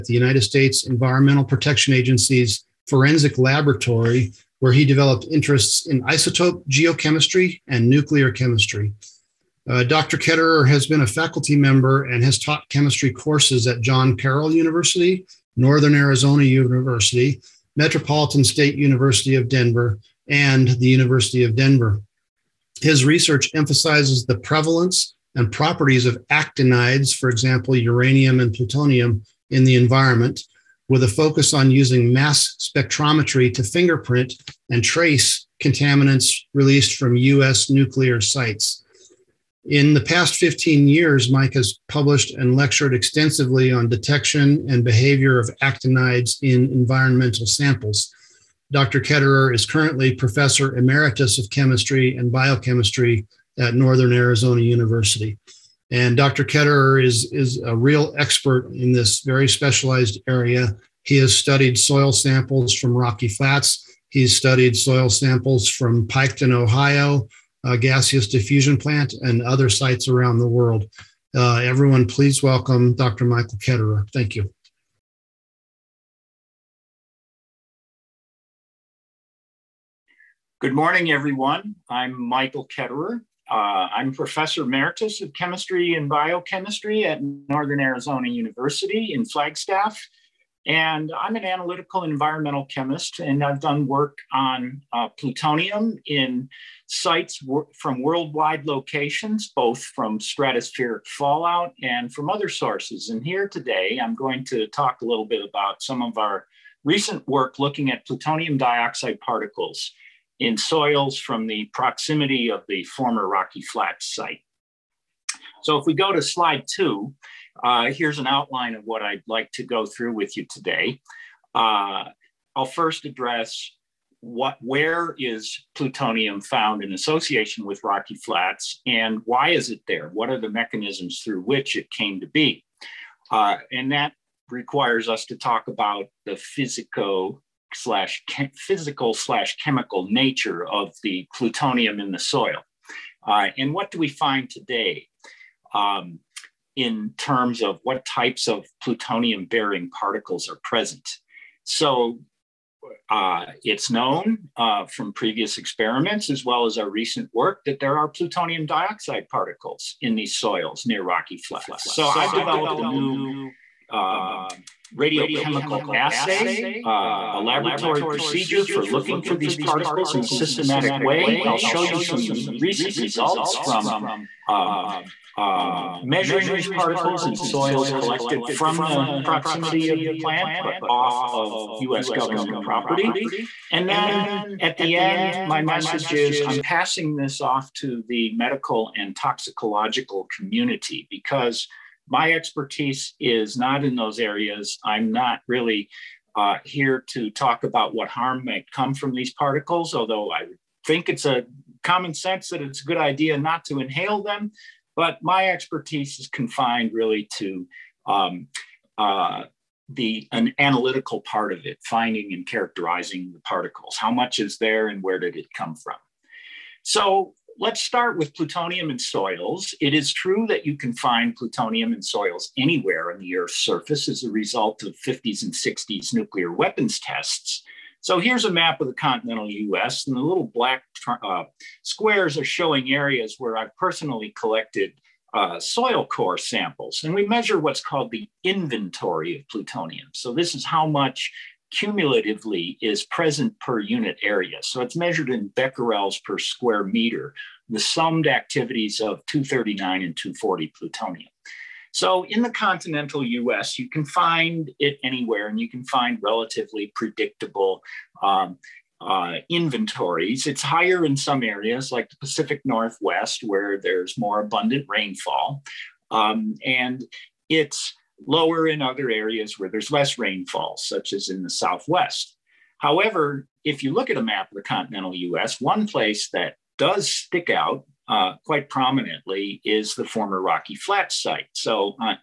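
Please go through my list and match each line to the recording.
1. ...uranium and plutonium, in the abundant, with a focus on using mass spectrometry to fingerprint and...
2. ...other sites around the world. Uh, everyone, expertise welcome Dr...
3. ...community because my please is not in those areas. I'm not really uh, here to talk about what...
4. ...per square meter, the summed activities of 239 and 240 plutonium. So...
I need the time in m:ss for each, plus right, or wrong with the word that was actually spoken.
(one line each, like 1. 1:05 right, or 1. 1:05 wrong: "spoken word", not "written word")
1. 0:27 wrong: "environment", not "abundant"
2. 1:09 wrong: "please", not "expertise"
3. 3:10 wrong: "expertise", not "please"
4. 4:06 right.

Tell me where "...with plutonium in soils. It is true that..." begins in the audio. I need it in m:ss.
3:38.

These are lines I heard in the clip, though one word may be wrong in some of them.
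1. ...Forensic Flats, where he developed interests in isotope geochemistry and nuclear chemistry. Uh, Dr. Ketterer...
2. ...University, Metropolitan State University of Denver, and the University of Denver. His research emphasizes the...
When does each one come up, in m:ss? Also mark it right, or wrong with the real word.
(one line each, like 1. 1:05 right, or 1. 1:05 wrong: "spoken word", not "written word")
1. 0:02 wrong: "Laboratory", not "Flats"
2. 0:16 right.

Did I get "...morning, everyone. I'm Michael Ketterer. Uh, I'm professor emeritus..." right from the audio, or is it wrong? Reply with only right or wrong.
right.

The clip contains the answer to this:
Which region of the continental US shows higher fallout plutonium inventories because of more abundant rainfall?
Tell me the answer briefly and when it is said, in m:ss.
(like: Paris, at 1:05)
Pacific Northwest, at 4:22.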